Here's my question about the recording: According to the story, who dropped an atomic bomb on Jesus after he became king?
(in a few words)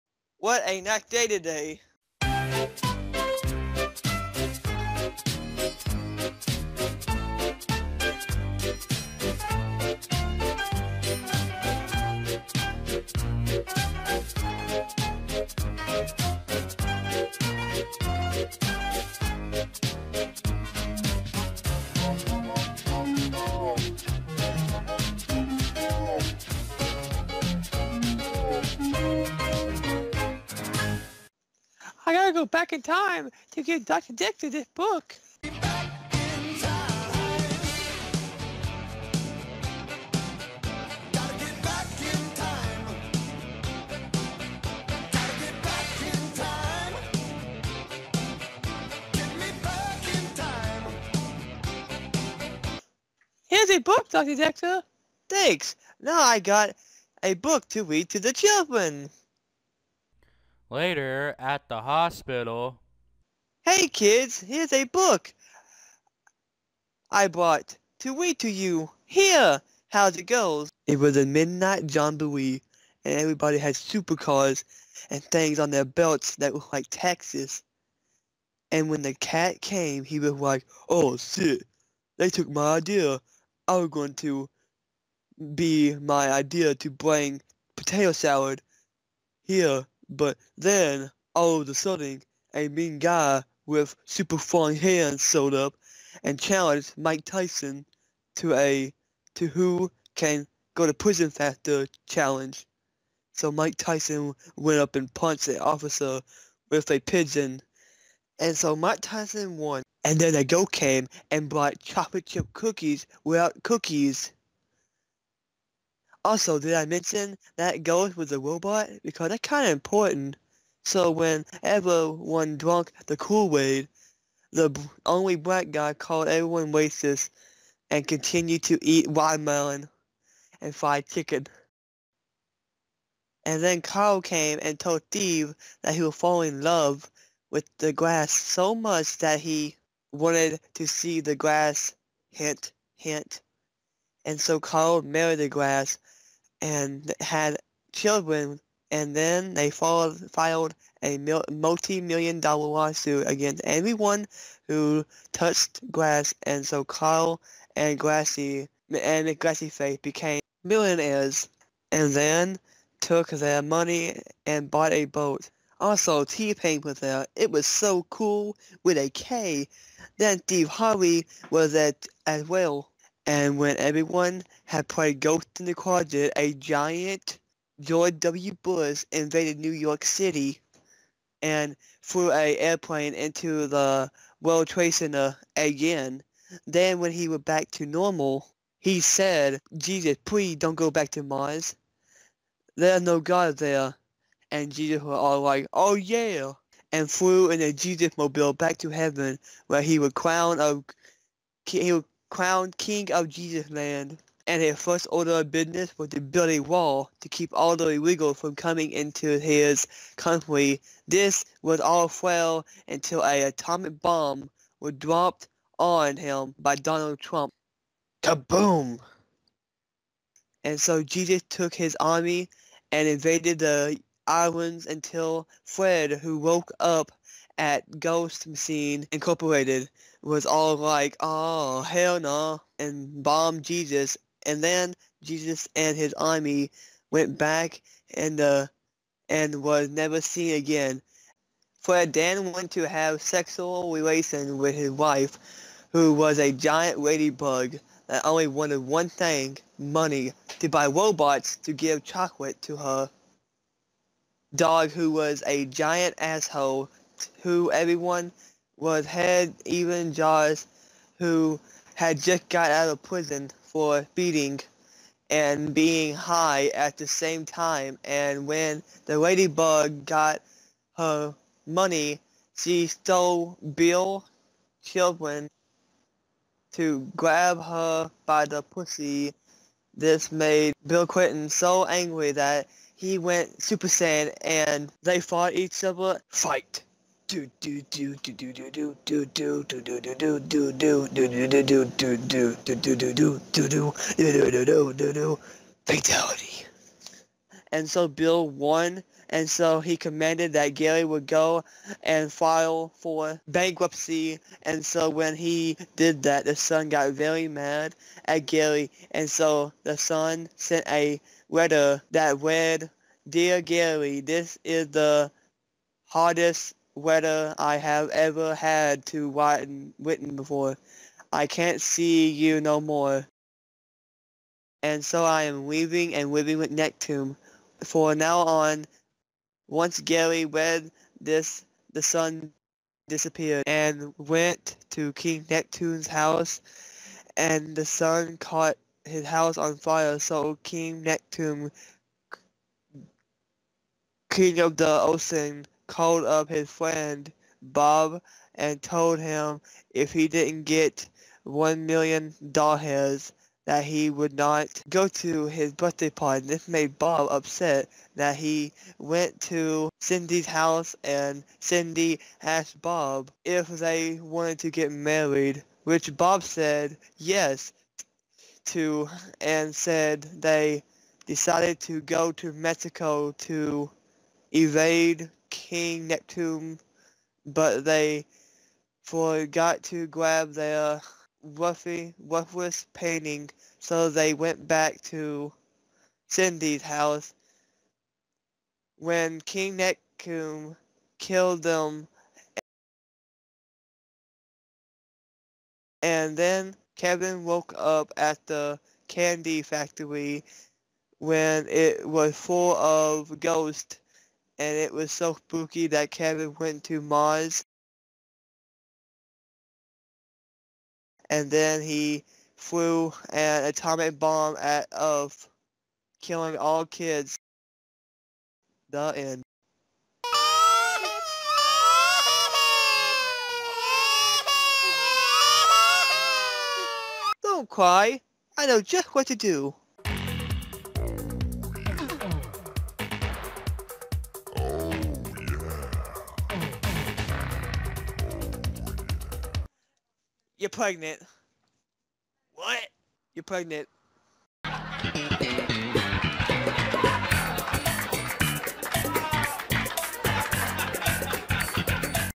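Donald Trump.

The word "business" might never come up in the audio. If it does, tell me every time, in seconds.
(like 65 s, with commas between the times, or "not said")
205 s.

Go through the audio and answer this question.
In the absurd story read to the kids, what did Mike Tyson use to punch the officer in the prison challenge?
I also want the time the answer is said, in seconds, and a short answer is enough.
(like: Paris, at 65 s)
A pigeon, at 106 s.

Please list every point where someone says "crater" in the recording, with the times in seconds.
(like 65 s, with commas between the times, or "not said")
not said.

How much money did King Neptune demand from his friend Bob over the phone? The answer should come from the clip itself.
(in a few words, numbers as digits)
$1 million.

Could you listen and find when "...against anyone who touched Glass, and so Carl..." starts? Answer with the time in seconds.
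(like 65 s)
153 s.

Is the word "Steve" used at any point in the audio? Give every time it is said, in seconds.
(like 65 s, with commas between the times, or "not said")
135 s, 170 s.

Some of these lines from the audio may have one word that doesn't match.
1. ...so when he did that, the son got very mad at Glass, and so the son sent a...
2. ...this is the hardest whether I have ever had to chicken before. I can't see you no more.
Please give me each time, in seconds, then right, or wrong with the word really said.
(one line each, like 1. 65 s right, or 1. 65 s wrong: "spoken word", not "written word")
1. 304 s wrong: "Gary", not "Glass"
2. 314 s wrong: "written", not "chicken".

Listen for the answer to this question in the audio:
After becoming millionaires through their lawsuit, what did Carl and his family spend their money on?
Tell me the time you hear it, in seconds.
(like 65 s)
164 s.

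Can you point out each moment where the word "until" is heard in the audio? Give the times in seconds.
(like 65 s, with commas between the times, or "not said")
212 s, 224 s.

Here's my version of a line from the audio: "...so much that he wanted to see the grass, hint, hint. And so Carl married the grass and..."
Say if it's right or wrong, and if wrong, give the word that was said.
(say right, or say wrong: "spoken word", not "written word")
right.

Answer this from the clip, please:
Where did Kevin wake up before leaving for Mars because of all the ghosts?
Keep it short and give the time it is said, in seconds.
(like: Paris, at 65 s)
Candy factory, at 399 s.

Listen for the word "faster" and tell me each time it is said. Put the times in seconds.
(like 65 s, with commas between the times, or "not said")
101 s.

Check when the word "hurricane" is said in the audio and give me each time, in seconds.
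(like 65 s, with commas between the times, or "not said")
not said.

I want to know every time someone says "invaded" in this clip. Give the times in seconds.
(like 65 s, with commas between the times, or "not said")
179 s, 223 s.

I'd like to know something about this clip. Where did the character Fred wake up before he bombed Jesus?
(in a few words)
Ghost Machine Incorporated.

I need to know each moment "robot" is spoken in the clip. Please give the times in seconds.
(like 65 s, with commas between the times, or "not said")
118 s, 250 s.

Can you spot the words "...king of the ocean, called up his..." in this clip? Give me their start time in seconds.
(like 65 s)
344 s.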